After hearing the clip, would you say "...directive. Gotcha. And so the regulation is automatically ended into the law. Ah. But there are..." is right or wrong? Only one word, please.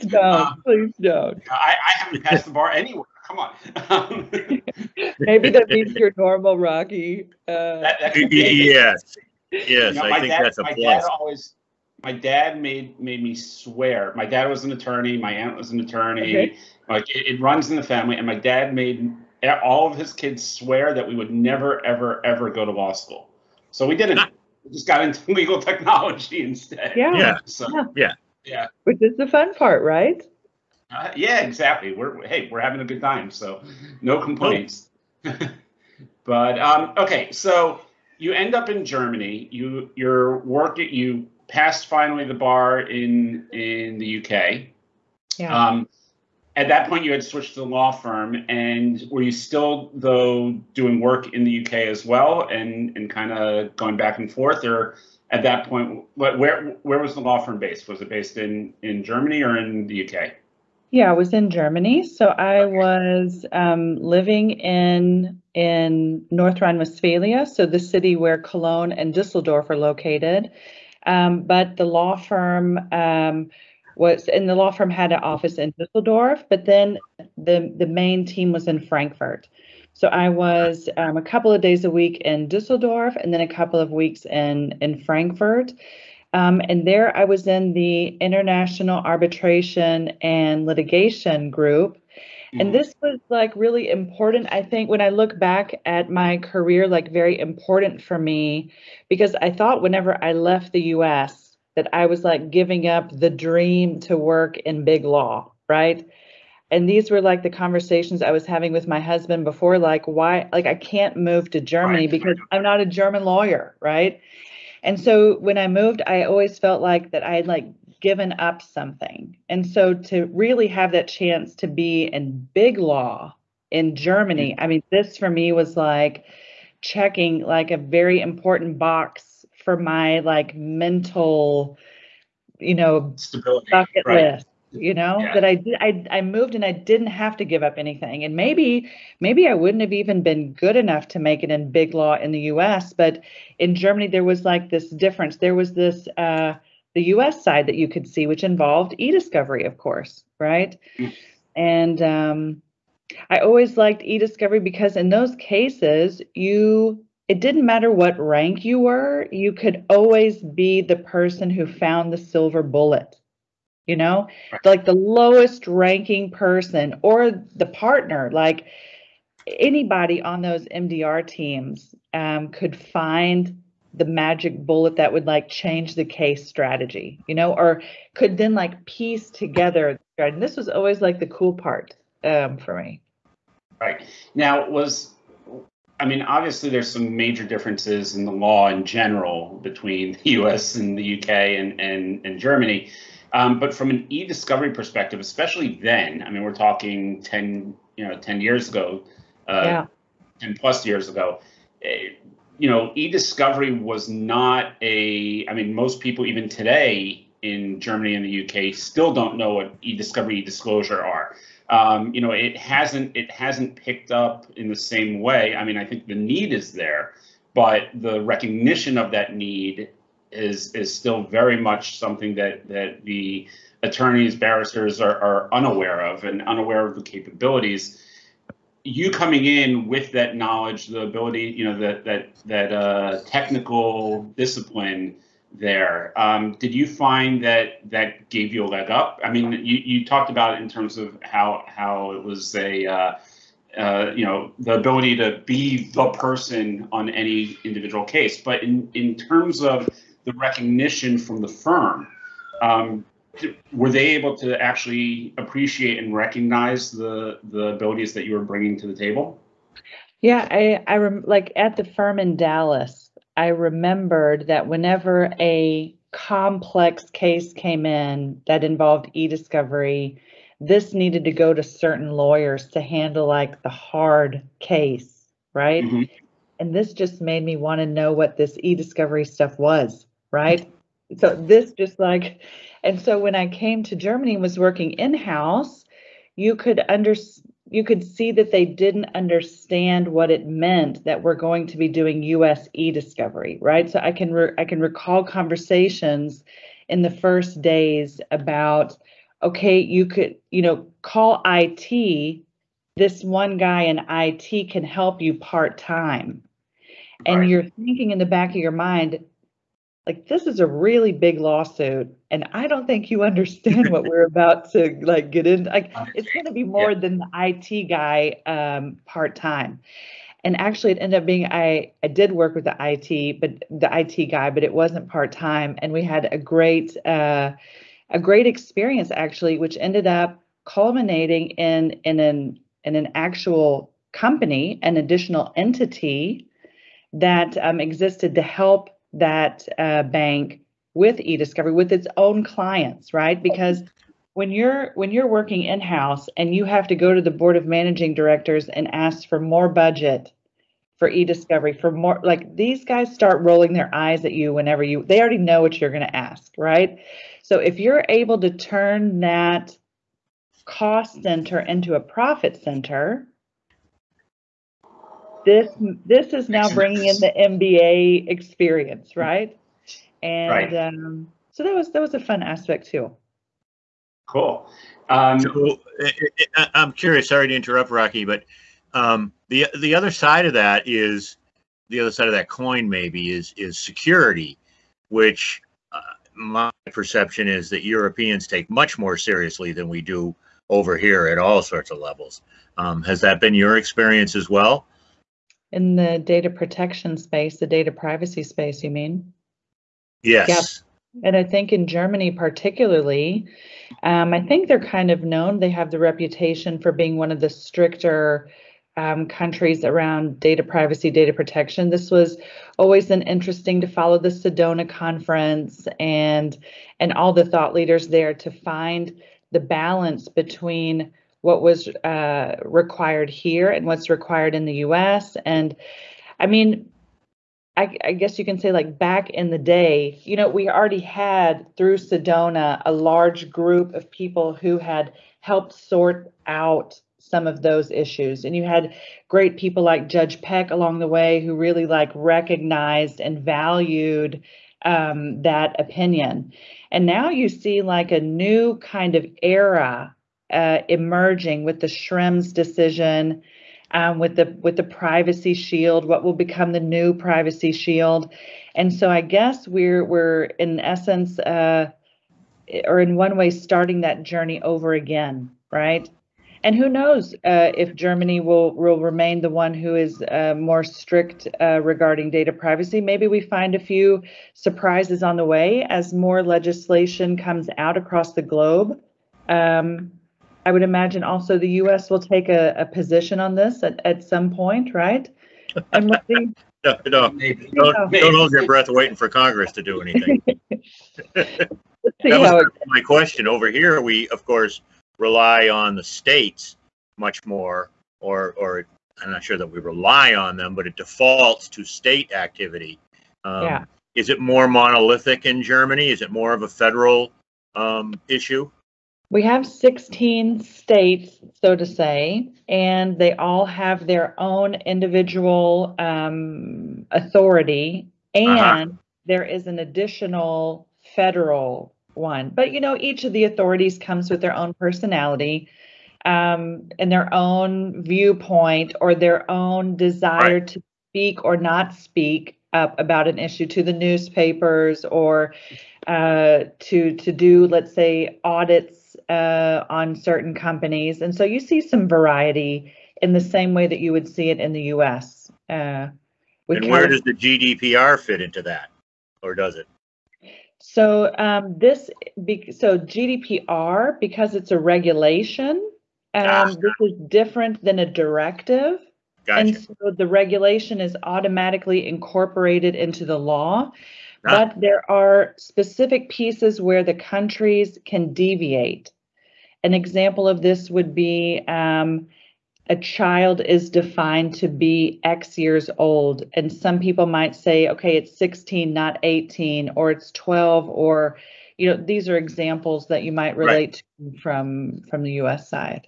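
wrong.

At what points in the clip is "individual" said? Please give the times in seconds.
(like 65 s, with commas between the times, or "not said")
247 s, 514 s.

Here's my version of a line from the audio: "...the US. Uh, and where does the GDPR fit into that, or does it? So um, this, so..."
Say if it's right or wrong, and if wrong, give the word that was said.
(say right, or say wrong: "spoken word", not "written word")
right.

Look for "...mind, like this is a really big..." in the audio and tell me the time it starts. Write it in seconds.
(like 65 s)
308 s.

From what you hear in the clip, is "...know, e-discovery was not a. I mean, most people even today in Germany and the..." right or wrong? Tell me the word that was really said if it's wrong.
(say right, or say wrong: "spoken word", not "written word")
right.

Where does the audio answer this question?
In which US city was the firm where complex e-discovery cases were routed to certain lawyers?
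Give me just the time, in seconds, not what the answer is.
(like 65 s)
262 s.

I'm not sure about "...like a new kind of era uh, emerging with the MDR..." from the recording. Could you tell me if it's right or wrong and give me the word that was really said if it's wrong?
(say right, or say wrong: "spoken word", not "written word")
wrong: "Schrems", not "MDR".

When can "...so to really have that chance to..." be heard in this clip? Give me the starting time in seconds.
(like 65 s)
119 s.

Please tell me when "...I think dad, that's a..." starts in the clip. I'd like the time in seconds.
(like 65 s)
10 s.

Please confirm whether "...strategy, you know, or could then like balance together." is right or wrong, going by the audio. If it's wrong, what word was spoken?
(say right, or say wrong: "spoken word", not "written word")
wrong: "piece", not "balance".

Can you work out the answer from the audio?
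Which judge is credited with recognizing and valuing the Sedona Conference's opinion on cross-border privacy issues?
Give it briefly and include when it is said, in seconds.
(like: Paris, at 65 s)
Judge Peck, at 440 s.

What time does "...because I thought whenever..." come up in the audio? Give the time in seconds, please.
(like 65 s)
99 s.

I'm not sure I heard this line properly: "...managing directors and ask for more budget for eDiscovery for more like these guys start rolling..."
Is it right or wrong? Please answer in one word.
right.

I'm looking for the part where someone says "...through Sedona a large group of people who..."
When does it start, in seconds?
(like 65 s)
431 s.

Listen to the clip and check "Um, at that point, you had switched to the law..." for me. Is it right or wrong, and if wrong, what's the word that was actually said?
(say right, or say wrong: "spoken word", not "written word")
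right.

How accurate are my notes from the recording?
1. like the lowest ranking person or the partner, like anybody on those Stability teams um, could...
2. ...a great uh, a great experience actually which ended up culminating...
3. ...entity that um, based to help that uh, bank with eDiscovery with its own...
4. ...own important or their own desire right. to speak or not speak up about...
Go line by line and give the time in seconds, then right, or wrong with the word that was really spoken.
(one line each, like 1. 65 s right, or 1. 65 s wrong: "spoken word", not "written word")
1. 164 s wrong: "MDR", not "Stability"
2. 326 s right
3. 335 s wrong: "existed", not "based"
4. 527 s wrong: "viewpoint", not "important".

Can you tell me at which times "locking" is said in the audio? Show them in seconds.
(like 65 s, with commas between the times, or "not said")
not said.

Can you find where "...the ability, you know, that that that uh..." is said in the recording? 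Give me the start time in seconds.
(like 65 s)
230 s.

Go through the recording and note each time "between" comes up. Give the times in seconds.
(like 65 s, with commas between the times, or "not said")
189 s, 420 s.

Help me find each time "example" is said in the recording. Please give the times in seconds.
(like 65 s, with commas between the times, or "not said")
569 s, 582 s.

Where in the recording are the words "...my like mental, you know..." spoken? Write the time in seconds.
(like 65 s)
129 s.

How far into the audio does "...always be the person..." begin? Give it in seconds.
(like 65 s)
159 s.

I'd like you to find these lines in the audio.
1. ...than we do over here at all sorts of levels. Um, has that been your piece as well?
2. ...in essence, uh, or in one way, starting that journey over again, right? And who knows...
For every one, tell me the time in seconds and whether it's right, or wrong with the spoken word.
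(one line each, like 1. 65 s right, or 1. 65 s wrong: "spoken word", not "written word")
1. 389 s wrong: "experience", not "piece"
2. 460 s right.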